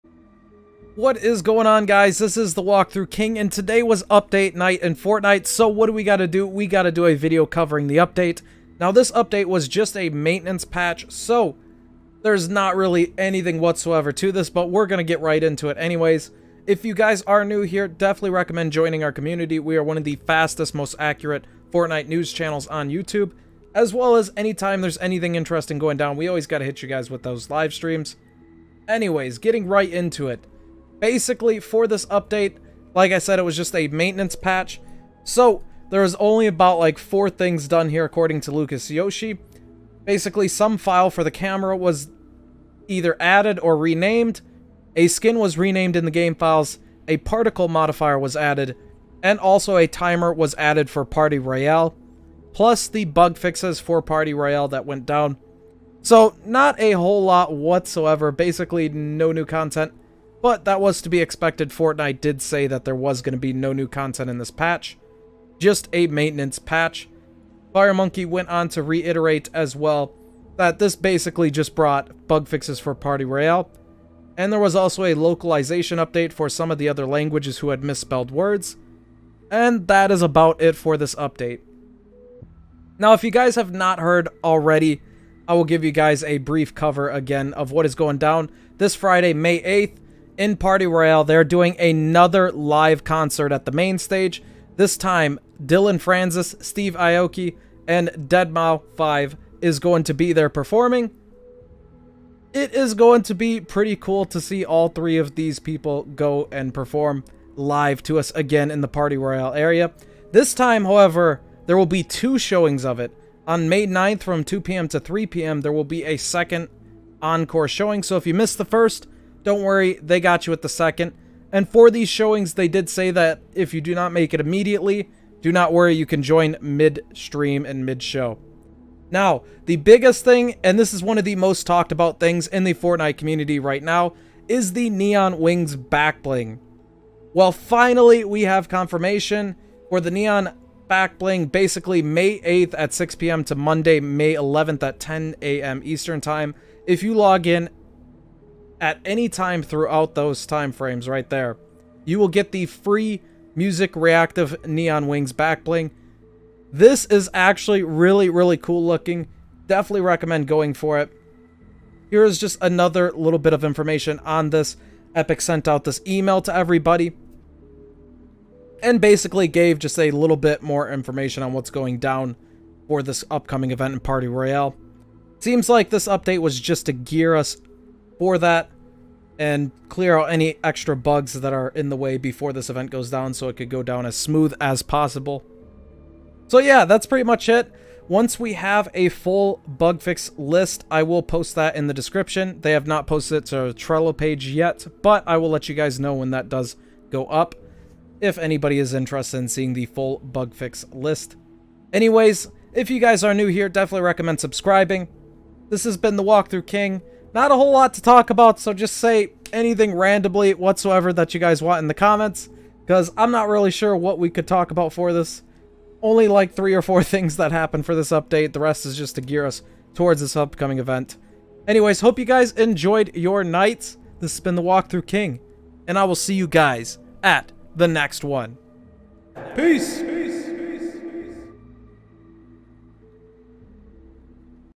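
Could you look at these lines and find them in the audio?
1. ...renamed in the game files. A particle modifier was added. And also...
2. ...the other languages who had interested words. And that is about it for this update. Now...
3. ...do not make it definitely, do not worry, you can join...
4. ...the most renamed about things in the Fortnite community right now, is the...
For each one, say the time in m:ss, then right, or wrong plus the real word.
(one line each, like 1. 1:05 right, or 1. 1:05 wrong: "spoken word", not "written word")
1. 0:45 right
2. 1:16 wrong: "misspelled", not "interested"
3. 2:03 wrong: "immediately", not "definitely"
4. 2:11 wrong: "talked", not "renamed".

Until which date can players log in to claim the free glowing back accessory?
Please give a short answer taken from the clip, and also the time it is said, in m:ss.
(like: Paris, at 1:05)
Monday, May 11th, at 2:23.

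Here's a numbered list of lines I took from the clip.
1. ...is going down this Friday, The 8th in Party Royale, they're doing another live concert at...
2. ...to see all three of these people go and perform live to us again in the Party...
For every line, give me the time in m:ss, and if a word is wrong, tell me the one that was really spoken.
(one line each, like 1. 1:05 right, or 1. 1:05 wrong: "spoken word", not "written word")
1. 1:27 wrong: "May", not "The"
2. 1:44 right.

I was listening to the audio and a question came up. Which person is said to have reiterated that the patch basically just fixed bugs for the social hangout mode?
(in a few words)
FireMonkey.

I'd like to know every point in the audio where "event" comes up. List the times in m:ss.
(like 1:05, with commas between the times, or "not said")
2:53, 3:02, 3:40.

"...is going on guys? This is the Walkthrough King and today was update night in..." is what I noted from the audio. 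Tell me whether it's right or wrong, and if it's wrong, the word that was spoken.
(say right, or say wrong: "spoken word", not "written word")
right.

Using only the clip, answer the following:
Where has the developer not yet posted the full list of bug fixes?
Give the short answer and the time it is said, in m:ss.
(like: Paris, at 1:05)
Trello, at 3:13.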